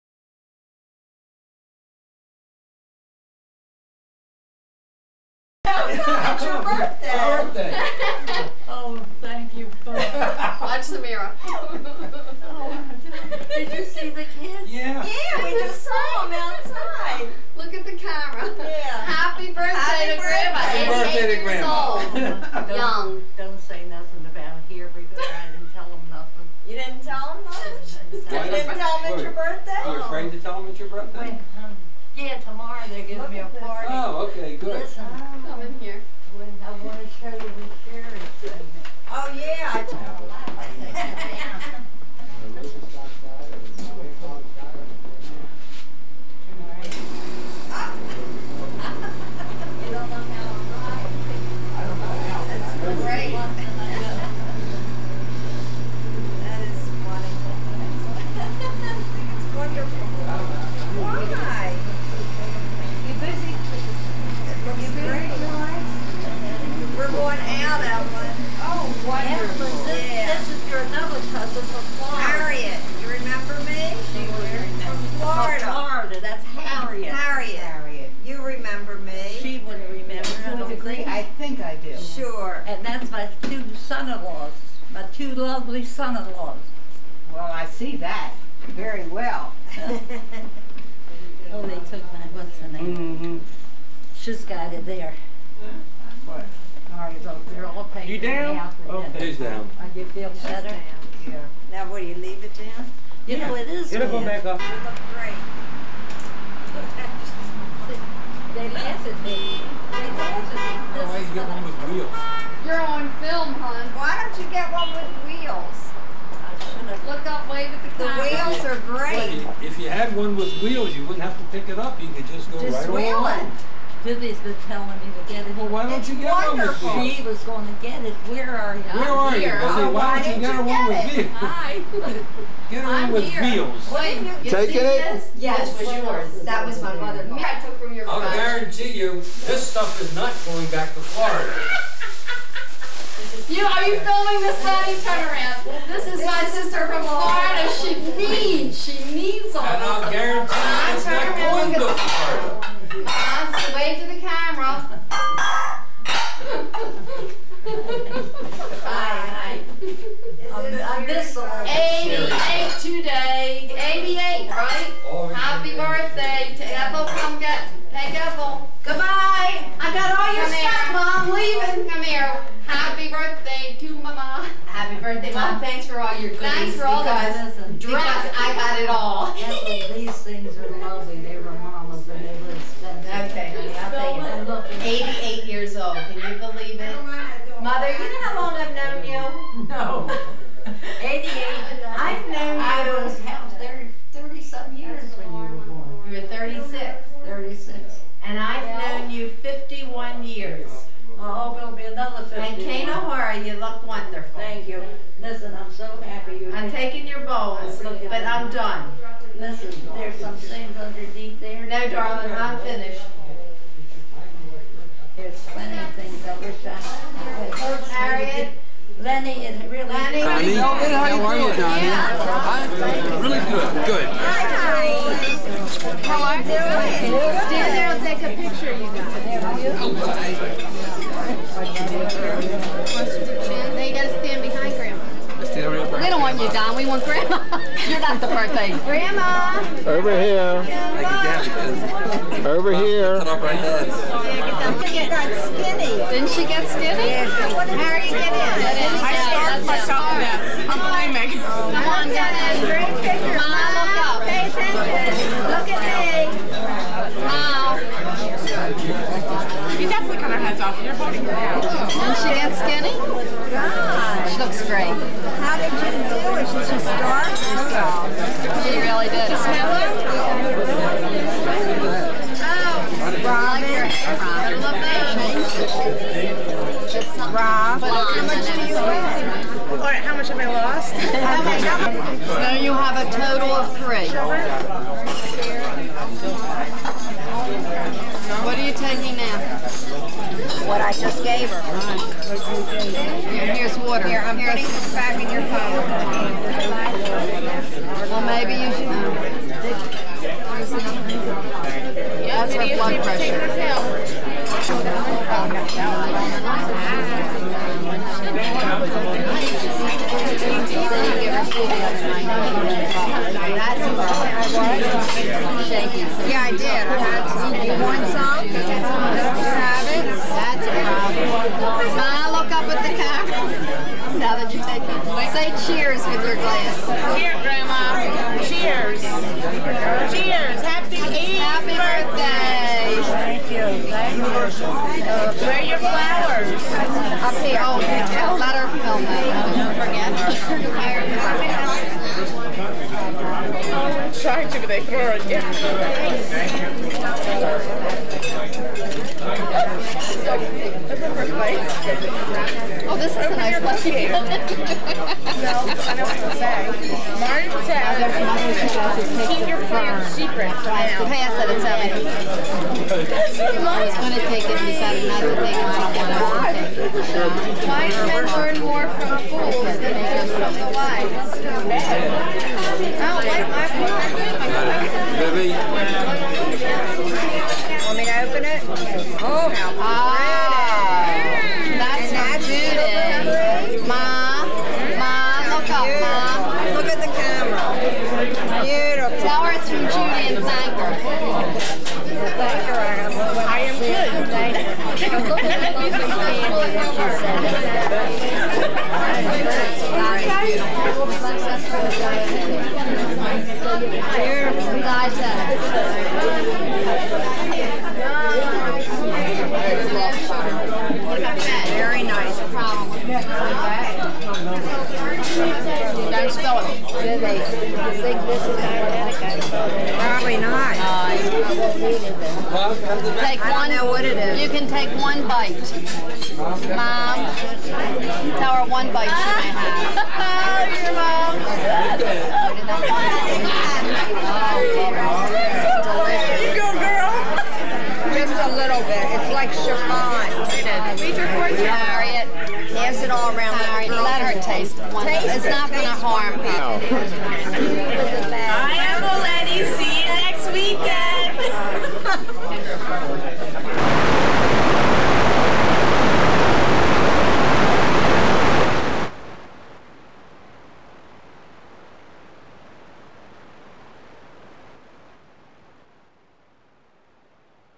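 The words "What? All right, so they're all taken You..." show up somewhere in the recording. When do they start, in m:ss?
1:36.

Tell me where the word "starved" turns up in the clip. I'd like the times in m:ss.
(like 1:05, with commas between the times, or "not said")
4:09, 4:26.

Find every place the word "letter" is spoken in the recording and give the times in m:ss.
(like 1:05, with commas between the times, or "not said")
5:38.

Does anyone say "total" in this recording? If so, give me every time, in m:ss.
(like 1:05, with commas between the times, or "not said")
4:43.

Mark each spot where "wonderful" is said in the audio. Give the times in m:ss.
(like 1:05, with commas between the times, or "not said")
2:06, 3:23.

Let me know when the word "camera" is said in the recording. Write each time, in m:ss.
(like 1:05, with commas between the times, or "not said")
2:34, 5:22.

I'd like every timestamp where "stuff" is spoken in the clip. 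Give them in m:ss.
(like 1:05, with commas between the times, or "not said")
2:19, 2:50.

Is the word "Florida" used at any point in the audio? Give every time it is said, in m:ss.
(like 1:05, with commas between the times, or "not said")
2:20, 2:27, 2:31.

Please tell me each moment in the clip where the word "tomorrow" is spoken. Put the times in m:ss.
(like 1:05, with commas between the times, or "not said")
0:32.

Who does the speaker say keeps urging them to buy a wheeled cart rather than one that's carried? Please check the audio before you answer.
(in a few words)
Vivi.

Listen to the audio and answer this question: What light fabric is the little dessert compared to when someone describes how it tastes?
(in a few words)
chiffon.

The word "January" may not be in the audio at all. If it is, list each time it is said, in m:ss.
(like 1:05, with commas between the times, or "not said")
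not said.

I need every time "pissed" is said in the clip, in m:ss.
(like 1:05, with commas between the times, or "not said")
not said.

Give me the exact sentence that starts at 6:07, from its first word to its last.
Wise men learn more from fools than they from the wise.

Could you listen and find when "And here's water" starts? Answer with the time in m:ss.
4:52.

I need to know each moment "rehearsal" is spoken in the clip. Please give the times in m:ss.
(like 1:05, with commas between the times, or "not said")
not said.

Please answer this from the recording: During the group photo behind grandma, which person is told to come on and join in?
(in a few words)
Dennis.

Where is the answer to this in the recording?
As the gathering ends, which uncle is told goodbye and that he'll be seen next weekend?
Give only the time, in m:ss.
7:28.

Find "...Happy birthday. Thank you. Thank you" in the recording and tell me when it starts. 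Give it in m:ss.
5:30.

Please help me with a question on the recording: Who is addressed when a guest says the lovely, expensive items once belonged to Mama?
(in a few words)
Evelyn.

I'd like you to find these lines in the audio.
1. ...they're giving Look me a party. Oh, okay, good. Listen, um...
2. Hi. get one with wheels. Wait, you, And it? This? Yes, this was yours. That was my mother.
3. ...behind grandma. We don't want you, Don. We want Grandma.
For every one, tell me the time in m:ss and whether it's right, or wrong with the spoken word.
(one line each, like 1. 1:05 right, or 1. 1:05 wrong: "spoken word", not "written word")
1. 0:32 right
2. 2:11 wrong: "Taking", not "And"
3. 3:54 right.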